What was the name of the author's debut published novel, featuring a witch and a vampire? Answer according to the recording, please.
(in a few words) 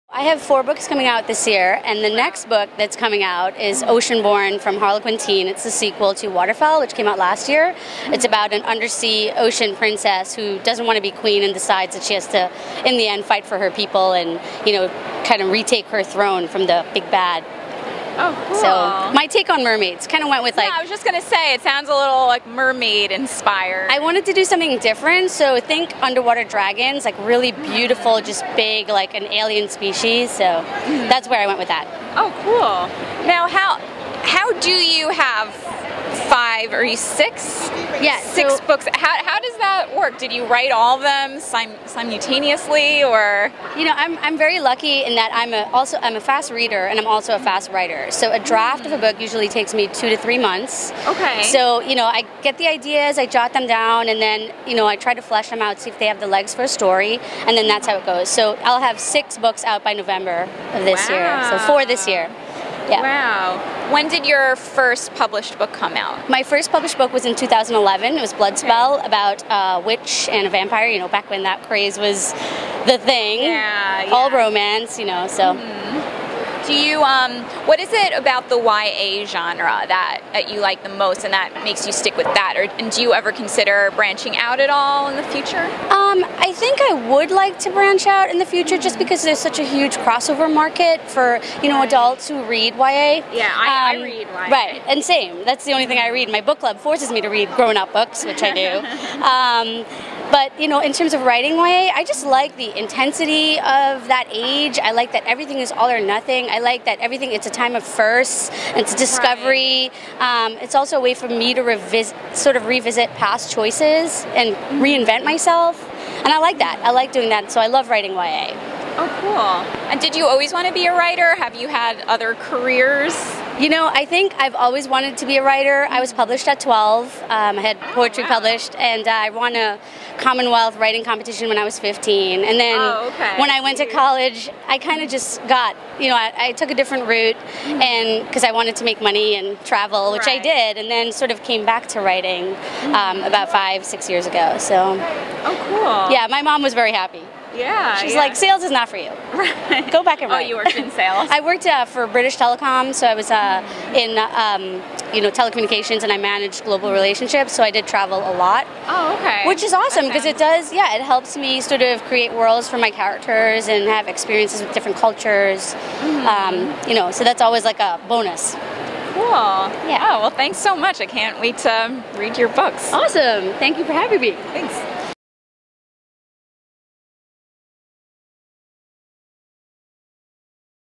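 Bloodspell.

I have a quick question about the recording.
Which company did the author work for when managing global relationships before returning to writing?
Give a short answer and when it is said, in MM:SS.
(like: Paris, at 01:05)
British Telecom, at 02:32.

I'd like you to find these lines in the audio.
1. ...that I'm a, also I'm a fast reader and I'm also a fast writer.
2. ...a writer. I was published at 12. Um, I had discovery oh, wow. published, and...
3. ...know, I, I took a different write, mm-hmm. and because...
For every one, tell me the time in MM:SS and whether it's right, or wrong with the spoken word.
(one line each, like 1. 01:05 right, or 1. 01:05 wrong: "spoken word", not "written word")
1. 00:45 right
2. 02:05 wrong: "poetry", not "discovery"
3. 02:16 wrong: "route", not "write".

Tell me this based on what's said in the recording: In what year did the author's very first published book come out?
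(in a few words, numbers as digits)
2011.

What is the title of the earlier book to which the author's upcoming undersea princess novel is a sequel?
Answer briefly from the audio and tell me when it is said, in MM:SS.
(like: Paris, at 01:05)
Waterfell, at 00:06.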